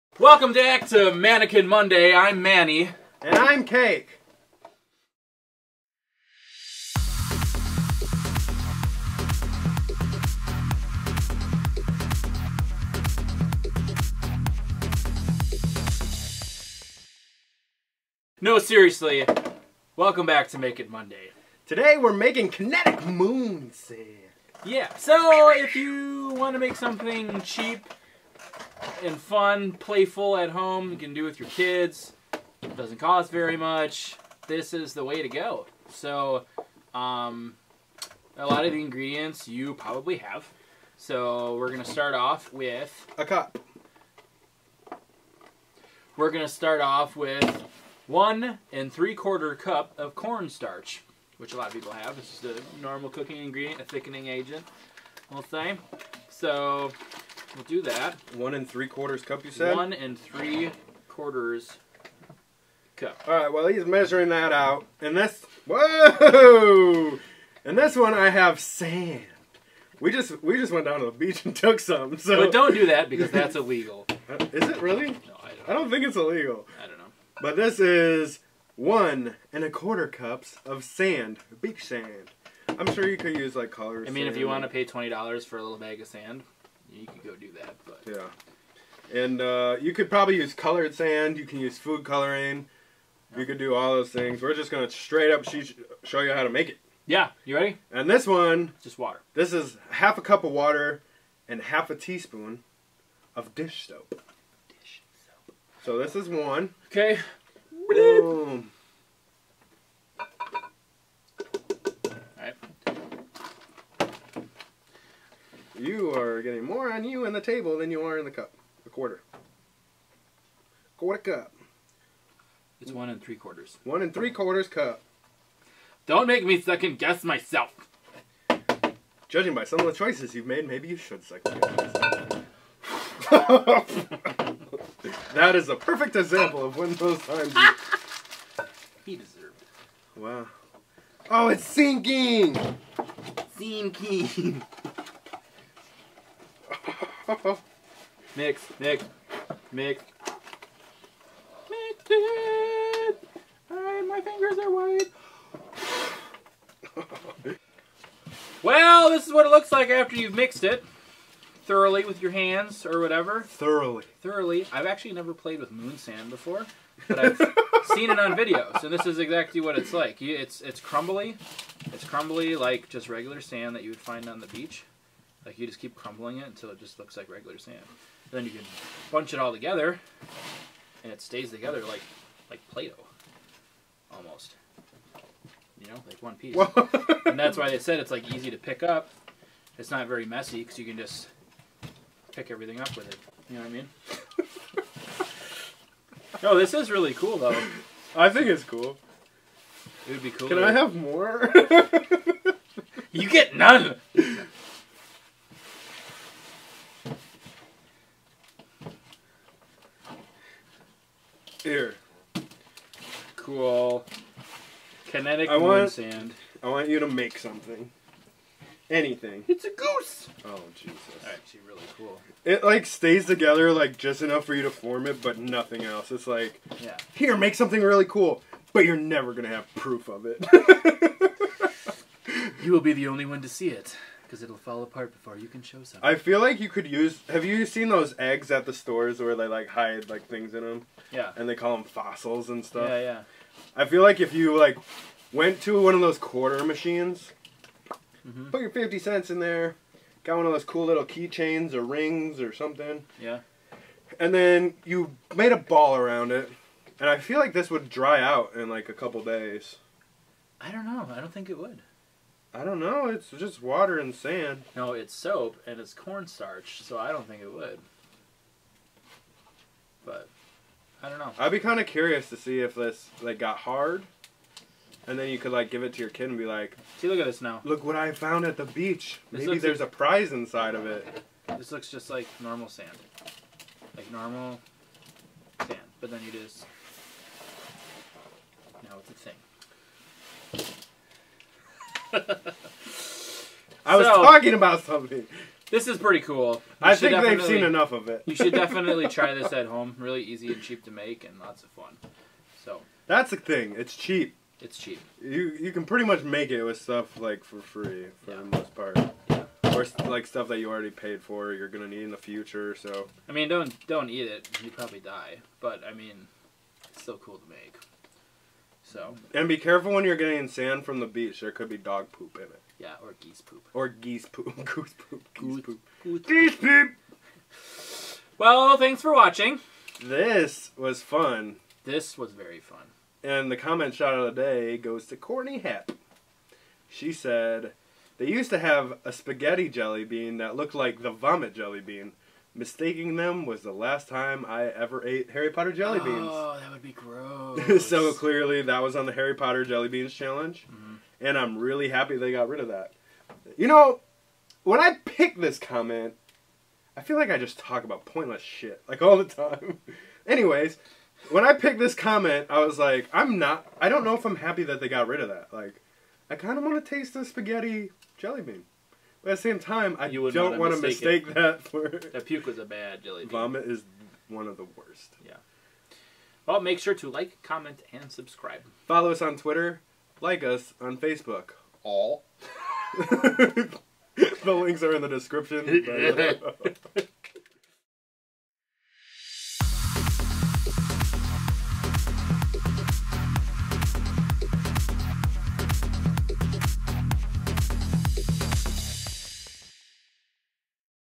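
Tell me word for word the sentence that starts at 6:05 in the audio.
Like, I kind of want to taste the spaghetti jelly bean.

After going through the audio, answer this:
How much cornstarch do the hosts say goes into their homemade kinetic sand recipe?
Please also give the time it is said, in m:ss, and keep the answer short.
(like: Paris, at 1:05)
1 3/4 cups, at 0:48.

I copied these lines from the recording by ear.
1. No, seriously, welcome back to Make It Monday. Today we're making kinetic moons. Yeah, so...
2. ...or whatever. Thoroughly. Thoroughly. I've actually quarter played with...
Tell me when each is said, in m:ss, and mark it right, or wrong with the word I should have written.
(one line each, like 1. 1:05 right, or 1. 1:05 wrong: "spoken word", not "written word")
1. 0:18 right
2. 2:42 wrong: "never", not "quarter".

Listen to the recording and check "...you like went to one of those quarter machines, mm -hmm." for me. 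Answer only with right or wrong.
right.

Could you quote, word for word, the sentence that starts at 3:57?
Have you seen those eggs at the stores where they like hide like things in them?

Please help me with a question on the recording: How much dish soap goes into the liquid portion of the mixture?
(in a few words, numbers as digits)
half a teaspoon.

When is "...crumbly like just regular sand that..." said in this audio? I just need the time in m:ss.
2:52.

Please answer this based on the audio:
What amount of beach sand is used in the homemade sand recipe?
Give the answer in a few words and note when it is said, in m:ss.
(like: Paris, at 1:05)
1 1/4 cups, at 1:18.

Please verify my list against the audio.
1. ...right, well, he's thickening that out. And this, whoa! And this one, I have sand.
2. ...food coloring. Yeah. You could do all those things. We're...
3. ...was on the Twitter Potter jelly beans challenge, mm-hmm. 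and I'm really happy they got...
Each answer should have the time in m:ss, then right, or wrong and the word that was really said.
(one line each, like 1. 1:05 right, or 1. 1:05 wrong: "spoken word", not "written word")
1. 1:03 wrong: "measuring", not "thickening"
2. 1:31 right
3. 5:48 wrong: "Harry", not "Twitter".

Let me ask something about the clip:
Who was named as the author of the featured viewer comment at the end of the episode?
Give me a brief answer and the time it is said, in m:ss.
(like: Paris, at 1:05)
Courtney Hep, at 5:35.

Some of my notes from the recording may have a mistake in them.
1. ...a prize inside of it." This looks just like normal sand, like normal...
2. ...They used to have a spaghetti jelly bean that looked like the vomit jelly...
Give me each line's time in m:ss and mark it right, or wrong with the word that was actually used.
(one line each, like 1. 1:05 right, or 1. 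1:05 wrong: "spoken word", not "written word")
1. 4:39 right
2. 5:38 right.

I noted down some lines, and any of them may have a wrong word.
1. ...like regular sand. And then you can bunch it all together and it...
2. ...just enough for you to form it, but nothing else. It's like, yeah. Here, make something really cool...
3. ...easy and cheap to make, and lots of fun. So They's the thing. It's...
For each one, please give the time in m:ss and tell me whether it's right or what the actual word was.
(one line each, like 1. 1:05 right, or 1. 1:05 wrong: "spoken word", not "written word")
1. 2:57 right
2. 3:43 right
3. 5:00 wrong: "That", not "They".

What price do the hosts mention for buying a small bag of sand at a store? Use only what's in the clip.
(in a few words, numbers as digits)
$20.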